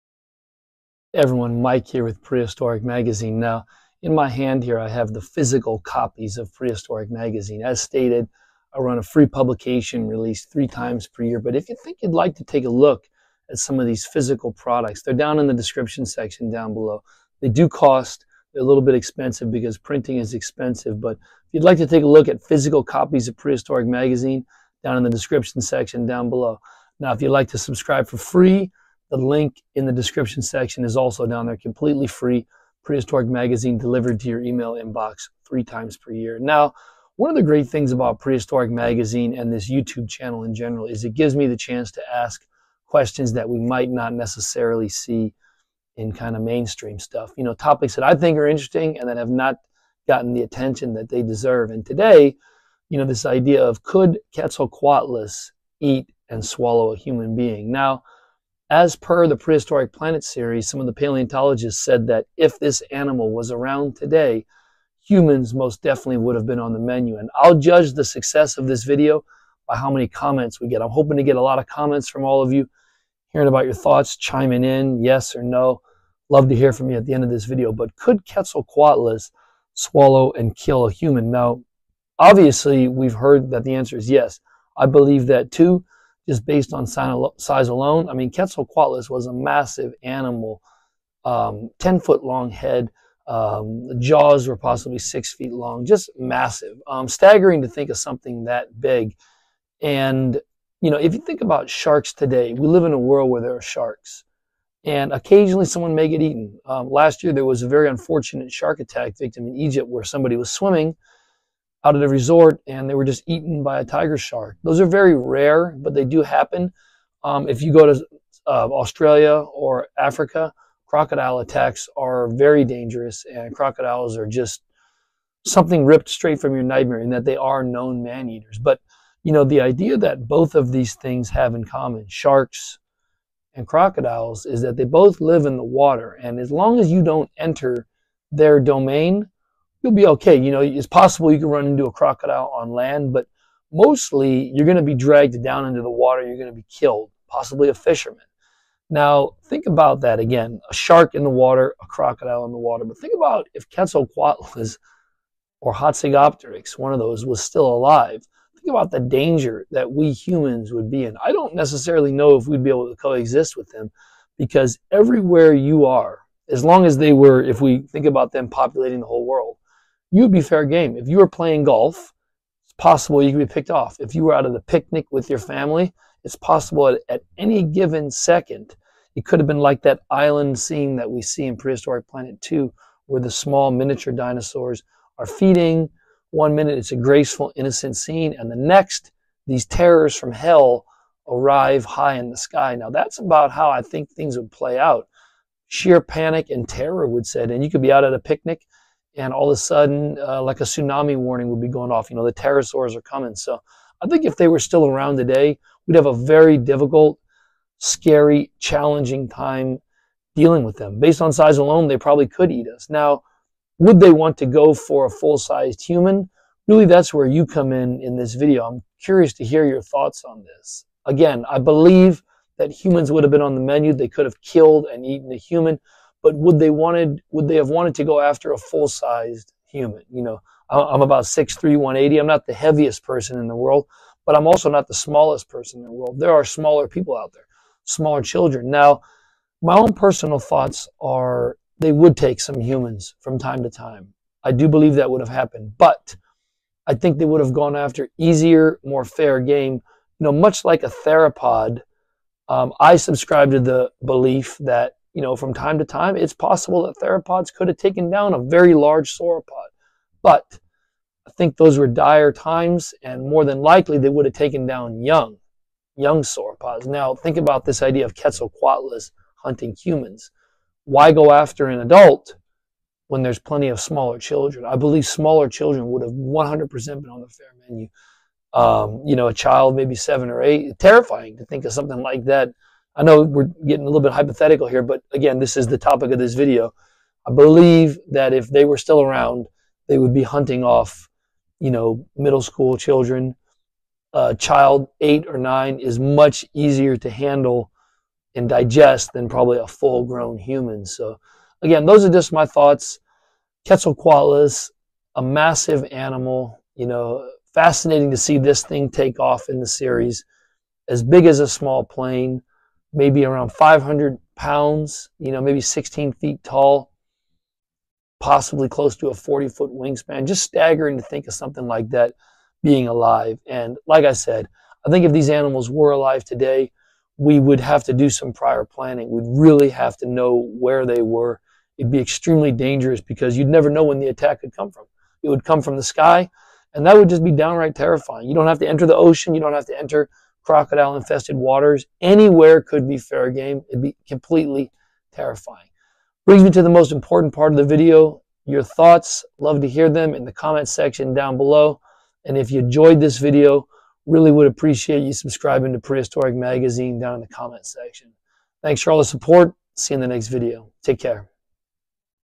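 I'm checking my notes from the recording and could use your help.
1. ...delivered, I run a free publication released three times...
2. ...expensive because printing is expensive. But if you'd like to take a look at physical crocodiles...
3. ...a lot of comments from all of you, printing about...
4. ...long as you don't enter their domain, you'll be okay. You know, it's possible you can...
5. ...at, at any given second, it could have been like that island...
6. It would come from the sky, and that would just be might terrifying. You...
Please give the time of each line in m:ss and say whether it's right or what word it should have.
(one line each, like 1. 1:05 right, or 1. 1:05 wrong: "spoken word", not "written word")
1. 0:07 wrong: "stated", not "delivered"
2. 0:18 wrong: "copies", not "crocodiles"
3. 1:11 wrong: "hearing", not "printing"
4. 2:16 right
5. 2:56 right
6. 5:35 wrong: "downright", not "might".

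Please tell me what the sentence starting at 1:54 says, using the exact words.
Those are very rare, but they do happen.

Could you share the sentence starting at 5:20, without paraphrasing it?
Just staggering to think of something like that being alive.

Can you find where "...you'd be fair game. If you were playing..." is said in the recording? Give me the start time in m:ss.
2:50.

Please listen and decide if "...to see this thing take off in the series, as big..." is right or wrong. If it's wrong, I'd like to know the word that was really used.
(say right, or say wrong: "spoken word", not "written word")
right.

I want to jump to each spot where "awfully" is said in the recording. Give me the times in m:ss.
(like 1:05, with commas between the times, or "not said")
not said.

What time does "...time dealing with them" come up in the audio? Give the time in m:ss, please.
3:29.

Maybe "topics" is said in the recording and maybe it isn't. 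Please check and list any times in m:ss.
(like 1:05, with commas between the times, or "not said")
0:47, 4:45.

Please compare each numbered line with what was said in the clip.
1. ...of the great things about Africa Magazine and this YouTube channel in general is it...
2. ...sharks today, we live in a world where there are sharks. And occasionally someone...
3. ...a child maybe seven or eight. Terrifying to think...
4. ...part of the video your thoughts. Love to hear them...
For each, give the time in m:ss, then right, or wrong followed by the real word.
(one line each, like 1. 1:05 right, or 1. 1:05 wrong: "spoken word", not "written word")
1. 0:37 wrong: "Prehistoric", not "Africa"
2. 1:41 right
3. 4:39 right
4. 5:47 right.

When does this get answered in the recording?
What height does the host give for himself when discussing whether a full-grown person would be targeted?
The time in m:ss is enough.
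3:51.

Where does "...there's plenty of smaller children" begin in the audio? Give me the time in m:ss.
4:33.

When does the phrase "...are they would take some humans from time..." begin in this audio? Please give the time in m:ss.
4:01.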